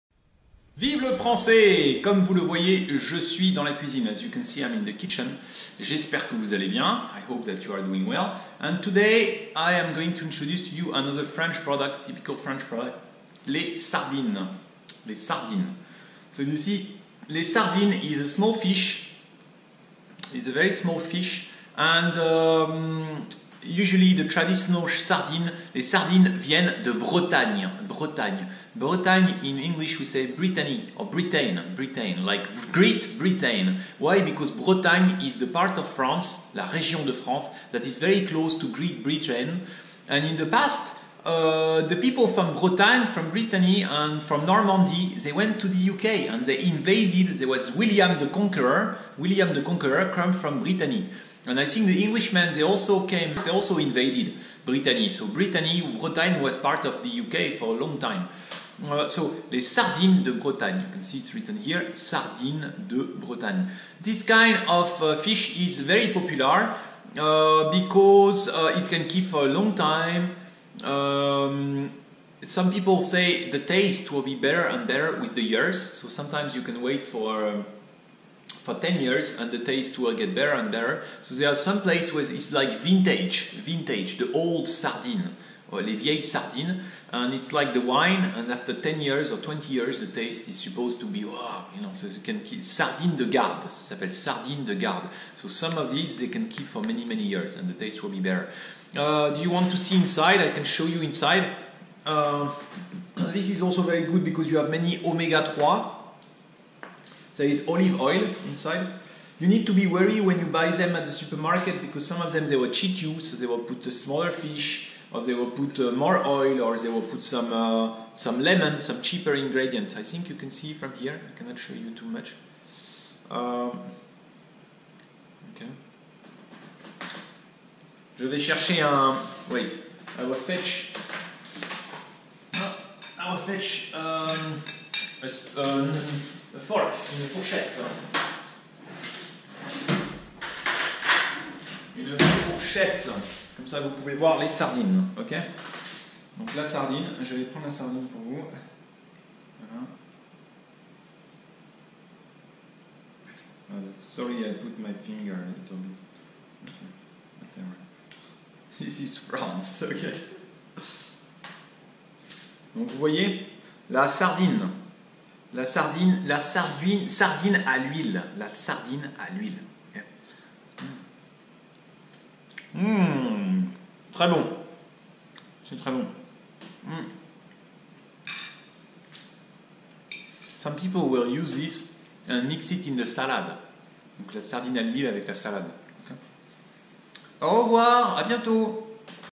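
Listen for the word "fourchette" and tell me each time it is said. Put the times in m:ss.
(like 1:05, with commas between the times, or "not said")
2:17, 2:22.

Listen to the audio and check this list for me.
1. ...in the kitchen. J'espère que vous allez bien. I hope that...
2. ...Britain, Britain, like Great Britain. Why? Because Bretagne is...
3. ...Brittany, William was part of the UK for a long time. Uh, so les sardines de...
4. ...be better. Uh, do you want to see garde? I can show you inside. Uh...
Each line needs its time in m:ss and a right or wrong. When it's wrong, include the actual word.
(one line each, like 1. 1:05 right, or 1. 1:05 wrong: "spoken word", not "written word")
1. 0:04 right
2. 0:31 right
3. 0:55 wrong: "Bretagne", not "William"
4. 1:38 wrong: "inside", not "garde".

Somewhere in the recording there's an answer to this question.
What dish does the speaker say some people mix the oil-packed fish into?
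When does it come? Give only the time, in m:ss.
3:02.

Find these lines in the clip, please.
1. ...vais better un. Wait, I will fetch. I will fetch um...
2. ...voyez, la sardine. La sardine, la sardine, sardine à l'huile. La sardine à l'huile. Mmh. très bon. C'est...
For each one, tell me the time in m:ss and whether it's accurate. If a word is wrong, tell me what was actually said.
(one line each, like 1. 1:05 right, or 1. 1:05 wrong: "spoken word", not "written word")
1. 2:08 wrong: "chercher", not "better"
2. 2:42 right.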